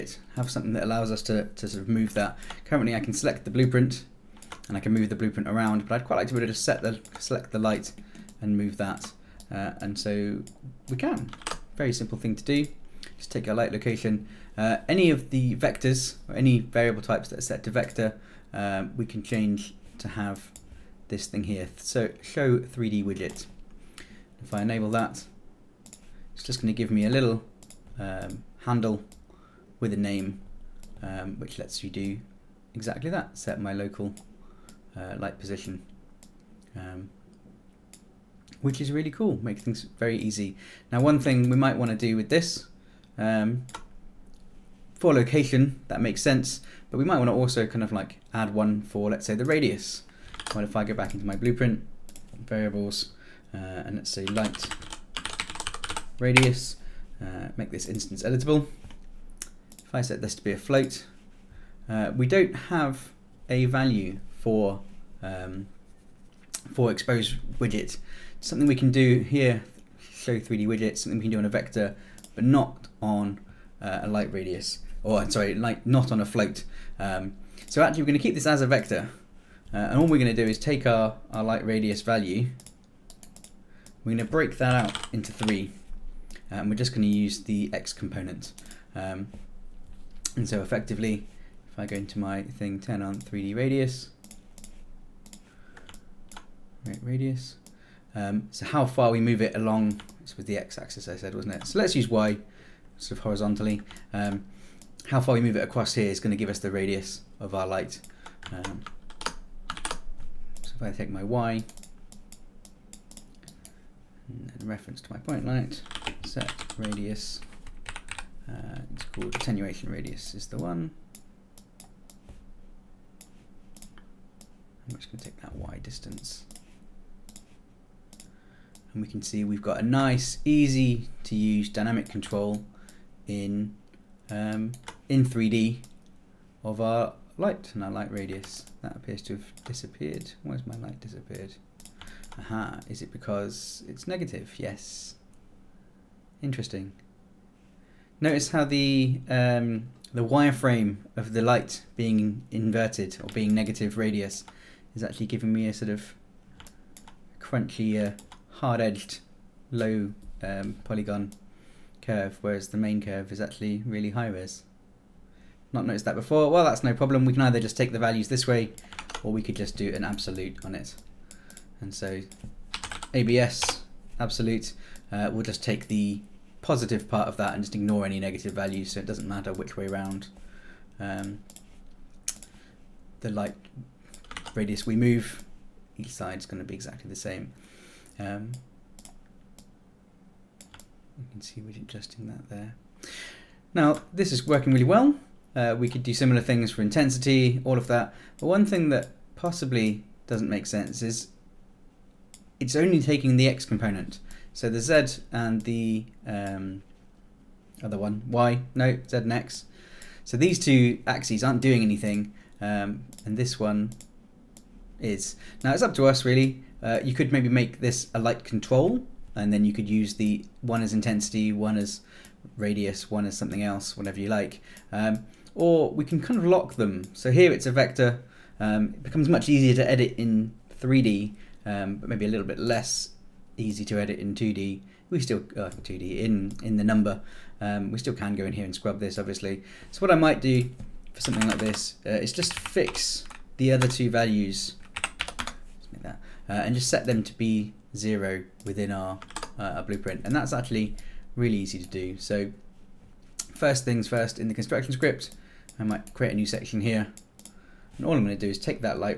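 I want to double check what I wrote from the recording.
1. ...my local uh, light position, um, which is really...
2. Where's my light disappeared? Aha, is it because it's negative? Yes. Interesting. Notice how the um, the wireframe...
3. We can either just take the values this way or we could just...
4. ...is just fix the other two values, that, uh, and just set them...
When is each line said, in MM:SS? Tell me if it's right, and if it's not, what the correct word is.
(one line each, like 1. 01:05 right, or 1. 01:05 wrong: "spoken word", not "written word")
1. 00:33 right
2. 02:20 right
3. 02:47 right
4. 04:02 right.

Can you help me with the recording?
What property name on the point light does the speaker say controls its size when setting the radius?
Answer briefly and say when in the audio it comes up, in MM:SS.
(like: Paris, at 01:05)
Attenuation radius, at 01:59.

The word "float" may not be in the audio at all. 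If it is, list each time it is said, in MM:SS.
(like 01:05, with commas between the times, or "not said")
01:00, 01:16.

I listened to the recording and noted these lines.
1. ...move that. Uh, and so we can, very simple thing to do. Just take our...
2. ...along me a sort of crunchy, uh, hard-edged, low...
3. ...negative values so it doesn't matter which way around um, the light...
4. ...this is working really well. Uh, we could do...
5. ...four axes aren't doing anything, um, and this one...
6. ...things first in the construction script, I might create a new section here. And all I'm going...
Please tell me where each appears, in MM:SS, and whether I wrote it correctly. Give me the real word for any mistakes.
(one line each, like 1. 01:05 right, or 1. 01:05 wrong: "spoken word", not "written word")
1. 00:08 right
2. 02:35 wrong: "giving", not "along"
3. 02:58 right
4. 03:14 right
5. 03:30 wrong: "two", not "four"
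6. 04:13 right.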